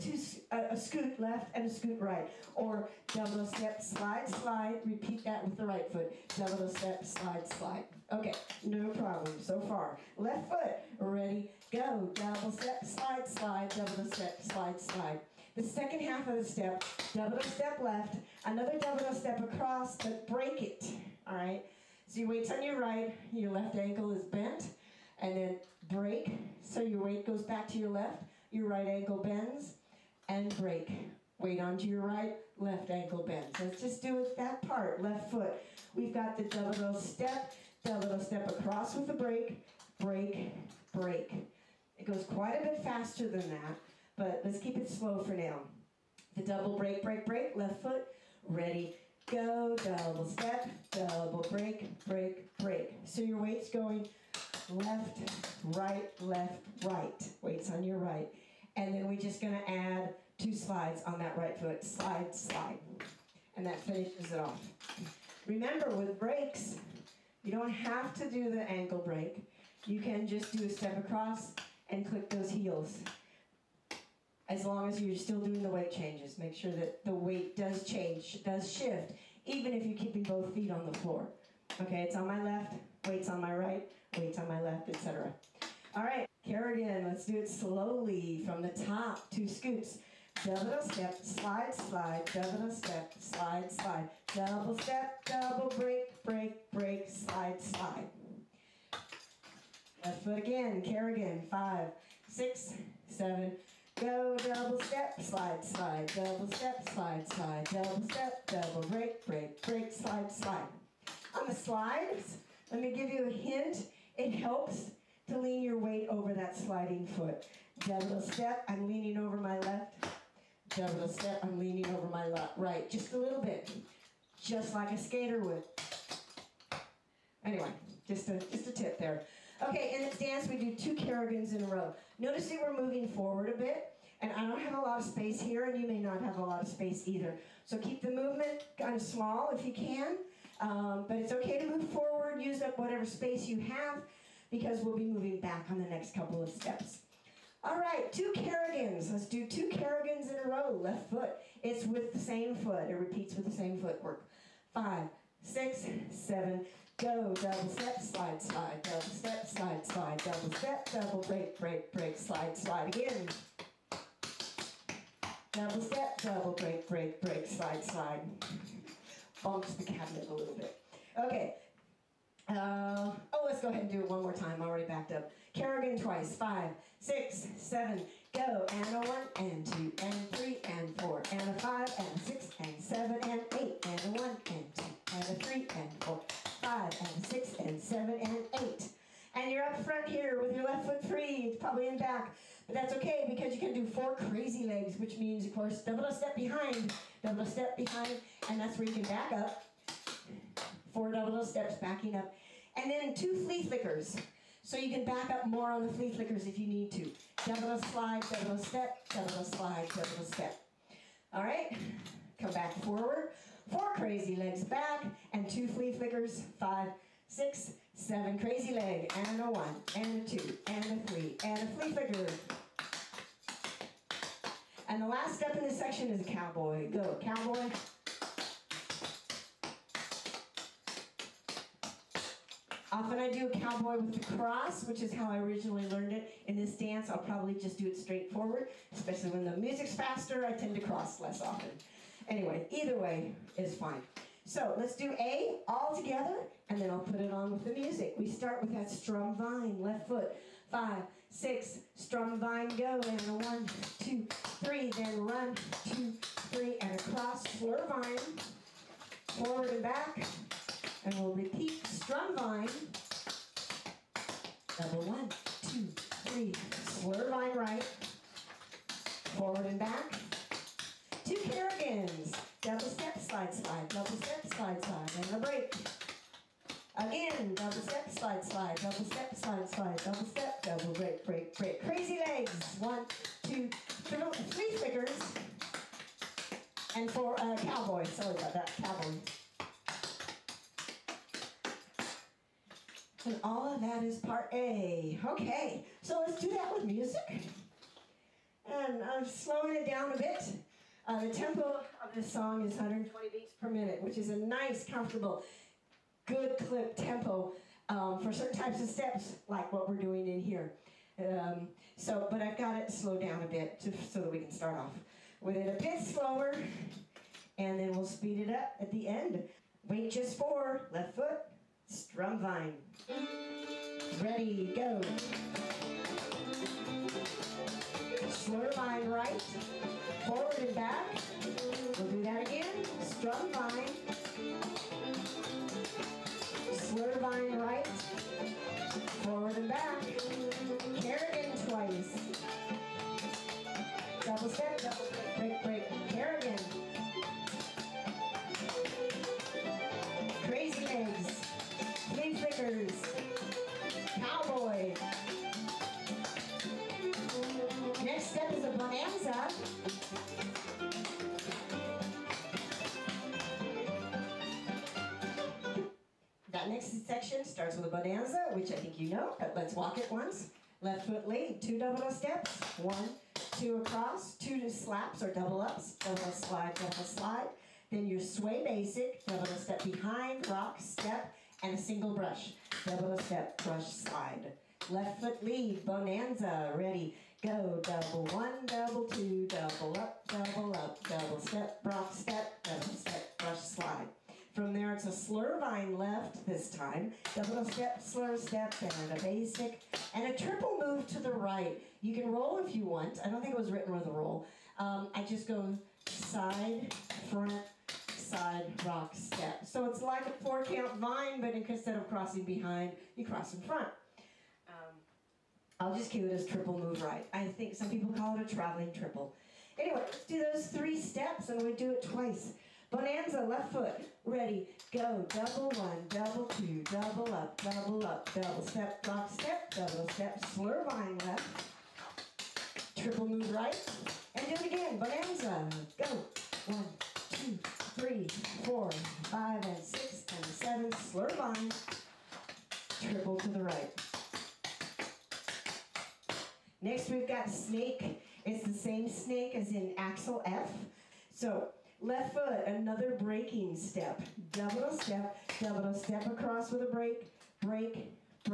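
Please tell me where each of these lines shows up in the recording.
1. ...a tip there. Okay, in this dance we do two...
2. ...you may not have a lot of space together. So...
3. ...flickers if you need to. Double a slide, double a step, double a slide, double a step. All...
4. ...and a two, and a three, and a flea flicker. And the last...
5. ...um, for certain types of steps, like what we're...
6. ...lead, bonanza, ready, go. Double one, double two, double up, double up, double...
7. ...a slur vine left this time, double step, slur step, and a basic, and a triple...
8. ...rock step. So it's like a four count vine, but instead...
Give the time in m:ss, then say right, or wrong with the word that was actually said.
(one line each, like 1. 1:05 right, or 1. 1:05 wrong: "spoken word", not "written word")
1. 2:08 right
2. 2:15 wrong: "either", not "together"
3. 3:26 right
4. 3:39 right
5. 5:07 right
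6. 6:25 right
7. 6:35 right
8. 6:48 right.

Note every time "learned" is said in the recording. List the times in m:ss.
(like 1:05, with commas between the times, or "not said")
3:55.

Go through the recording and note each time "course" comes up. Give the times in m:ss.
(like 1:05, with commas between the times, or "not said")
3:15.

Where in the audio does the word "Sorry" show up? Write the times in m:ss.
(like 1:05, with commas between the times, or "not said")
4:48.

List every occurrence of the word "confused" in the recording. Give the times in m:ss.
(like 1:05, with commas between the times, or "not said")
not said.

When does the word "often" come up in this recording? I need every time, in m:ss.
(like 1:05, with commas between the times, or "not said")
3:52, 4:01.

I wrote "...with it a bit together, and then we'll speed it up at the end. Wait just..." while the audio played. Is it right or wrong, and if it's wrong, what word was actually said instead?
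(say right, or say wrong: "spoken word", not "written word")
wrong: "slower", not "together".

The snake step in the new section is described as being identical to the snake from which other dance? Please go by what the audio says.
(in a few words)
Axel F.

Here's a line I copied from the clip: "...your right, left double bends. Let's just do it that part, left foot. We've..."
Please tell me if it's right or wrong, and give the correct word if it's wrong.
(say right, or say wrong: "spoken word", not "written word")
wrong: "ankle", not "double".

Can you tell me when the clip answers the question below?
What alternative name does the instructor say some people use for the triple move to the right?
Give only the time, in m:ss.
6:58.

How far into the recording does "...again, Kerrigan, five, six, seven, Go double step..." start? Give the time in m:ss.
1:40.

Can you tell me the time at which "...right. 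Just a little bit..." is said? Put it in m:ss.
2:02.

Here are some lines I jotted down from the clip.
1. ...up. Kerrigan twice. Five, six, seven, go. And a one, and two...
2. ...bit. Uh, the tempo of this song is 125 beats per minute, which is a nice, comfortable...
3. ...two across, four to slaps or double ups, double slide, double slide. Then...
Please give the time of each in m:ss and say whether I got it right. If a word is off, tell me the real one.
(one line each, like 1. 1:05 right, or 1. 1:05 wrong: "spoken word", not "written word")
1. 2:55 right
2. 5:00 wrong: "120", not "125"
3. 6:13 wrong: "two", not "four".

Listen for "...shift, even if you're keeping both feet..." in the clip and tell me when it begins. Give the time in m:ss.
1:18.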